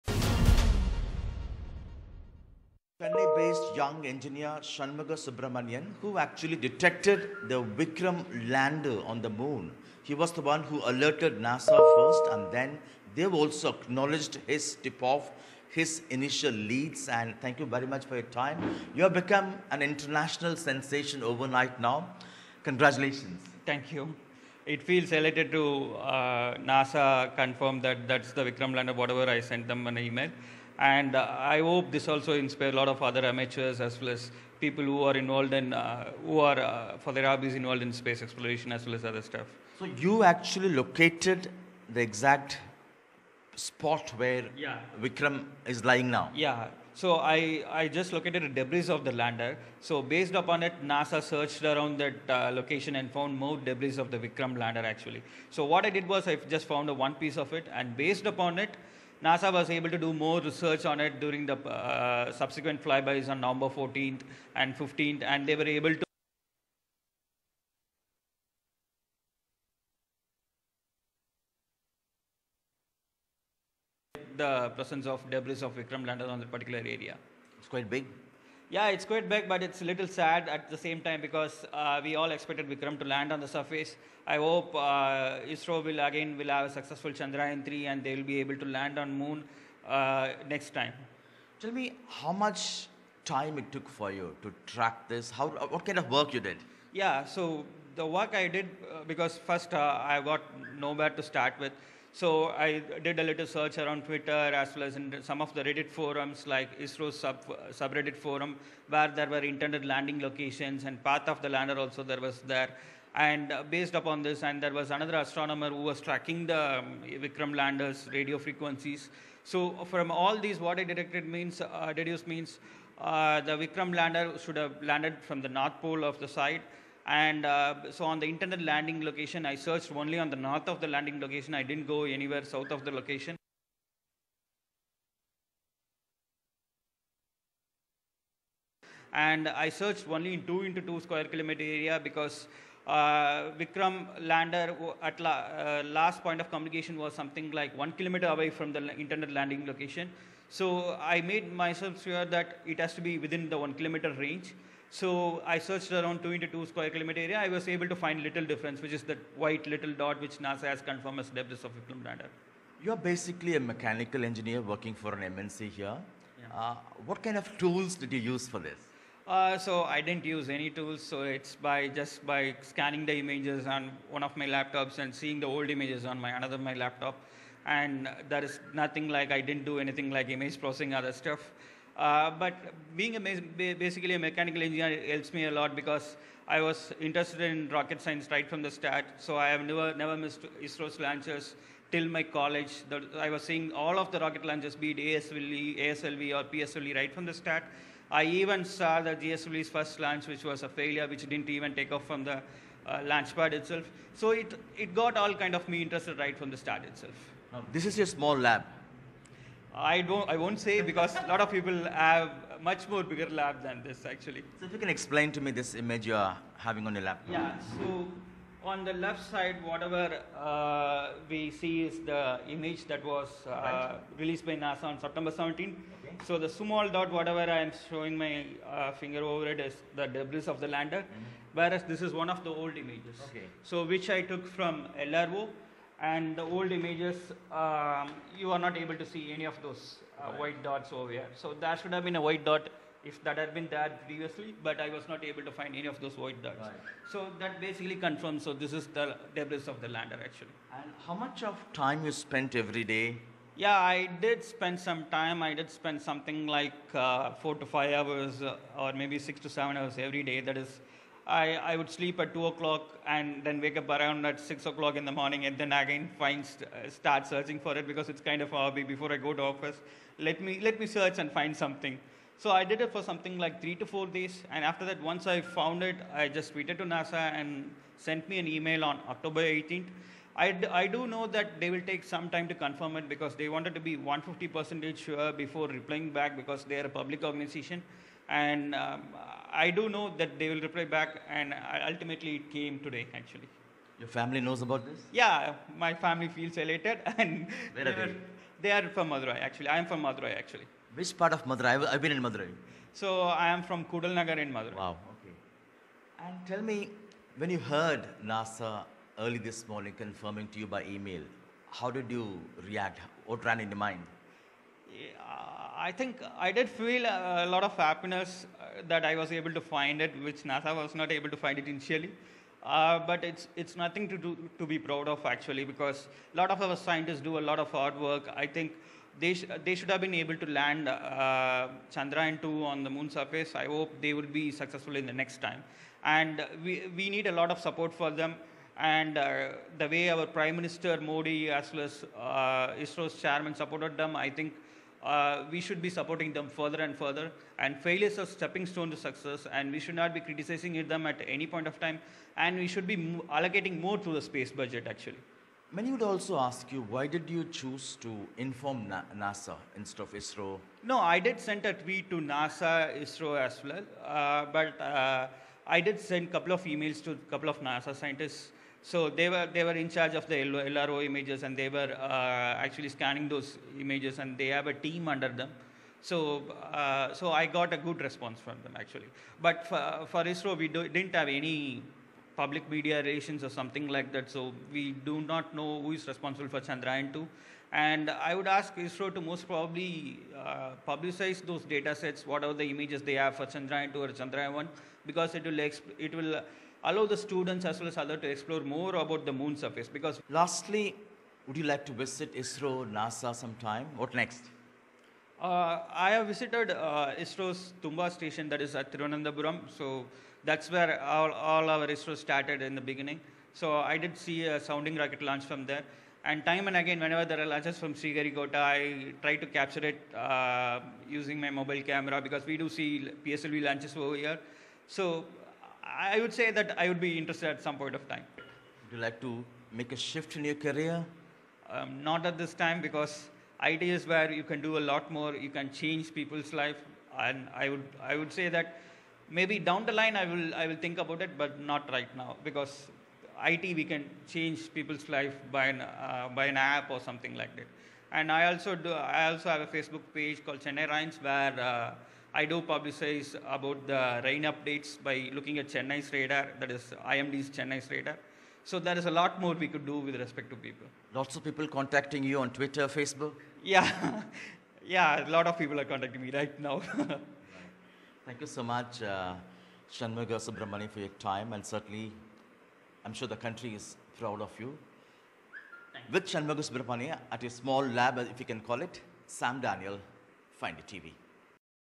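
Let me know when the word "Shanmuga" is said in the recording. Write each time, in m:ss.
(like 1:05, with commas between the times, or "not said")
0:04, 7:49, 7:56.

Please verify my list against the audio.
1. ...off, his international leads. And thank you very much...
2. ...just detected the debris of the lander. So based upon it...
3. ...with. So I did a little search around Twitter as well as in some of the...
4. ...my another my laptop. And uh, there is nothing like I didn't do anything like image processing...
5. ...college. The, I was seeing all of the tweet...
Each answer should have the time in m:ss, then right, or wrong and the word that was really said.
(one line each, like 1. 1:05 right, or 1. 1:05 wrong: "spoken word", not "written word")
1. 0:15 wrong: "initial", not "international"
2. 0:47 wrong: "located", not "detected"
3. 1:41 right
4. 2:56 right
5. 3:12 wrong: "rocket", not "tweet".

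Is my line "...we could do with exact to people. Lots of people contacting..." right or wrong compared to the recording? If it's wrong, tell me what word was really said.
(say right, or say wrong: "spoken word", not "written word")
wrong: "respect", not "exact".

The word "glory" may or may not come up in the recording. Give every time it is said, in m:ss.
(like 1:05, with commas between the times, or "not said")
not said.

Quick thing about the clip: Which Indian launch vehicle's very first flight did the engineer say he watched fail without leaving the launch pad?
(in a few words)
GSLV.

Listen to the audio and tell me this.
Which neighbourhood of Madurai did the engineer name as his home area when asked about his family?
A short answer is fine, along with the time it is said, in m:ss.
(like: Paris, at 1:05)
Kudalnagar, at 5:03.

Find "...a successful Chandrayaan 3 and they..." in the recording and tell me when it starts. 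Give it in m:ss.
1:26.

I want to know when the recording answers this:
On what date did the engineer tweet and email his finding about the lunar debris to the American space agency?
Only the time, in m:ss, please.
4:39.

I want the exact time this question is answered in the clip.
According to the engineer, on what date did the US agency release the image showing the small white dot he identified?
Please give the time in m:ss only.
3:44.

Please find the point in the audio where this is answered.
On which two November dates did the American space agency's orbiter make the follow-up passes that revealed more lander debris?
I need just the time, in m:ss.
1:03.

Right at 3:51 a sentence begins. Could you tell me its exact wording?
whereas this is one of the old images.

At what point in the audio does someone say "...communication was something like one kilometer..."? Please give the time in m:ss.
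2:26.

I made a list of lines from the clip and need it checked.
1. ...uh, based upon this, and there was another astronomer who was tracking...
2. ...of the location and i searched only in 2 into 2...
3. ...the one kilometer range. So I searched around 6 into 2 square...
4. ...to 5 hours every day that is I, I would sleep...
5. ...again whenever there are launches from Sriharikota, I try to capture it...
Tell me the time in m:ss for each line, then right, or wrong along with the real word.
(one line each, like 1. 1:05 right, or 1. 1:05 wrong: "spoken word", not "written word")
1. 1:53 right
2. 2:12 right
3. 2:33 wrong: "2", not "6"
4. 4:19 wrong: "7", not "5"
5. 6:56 right.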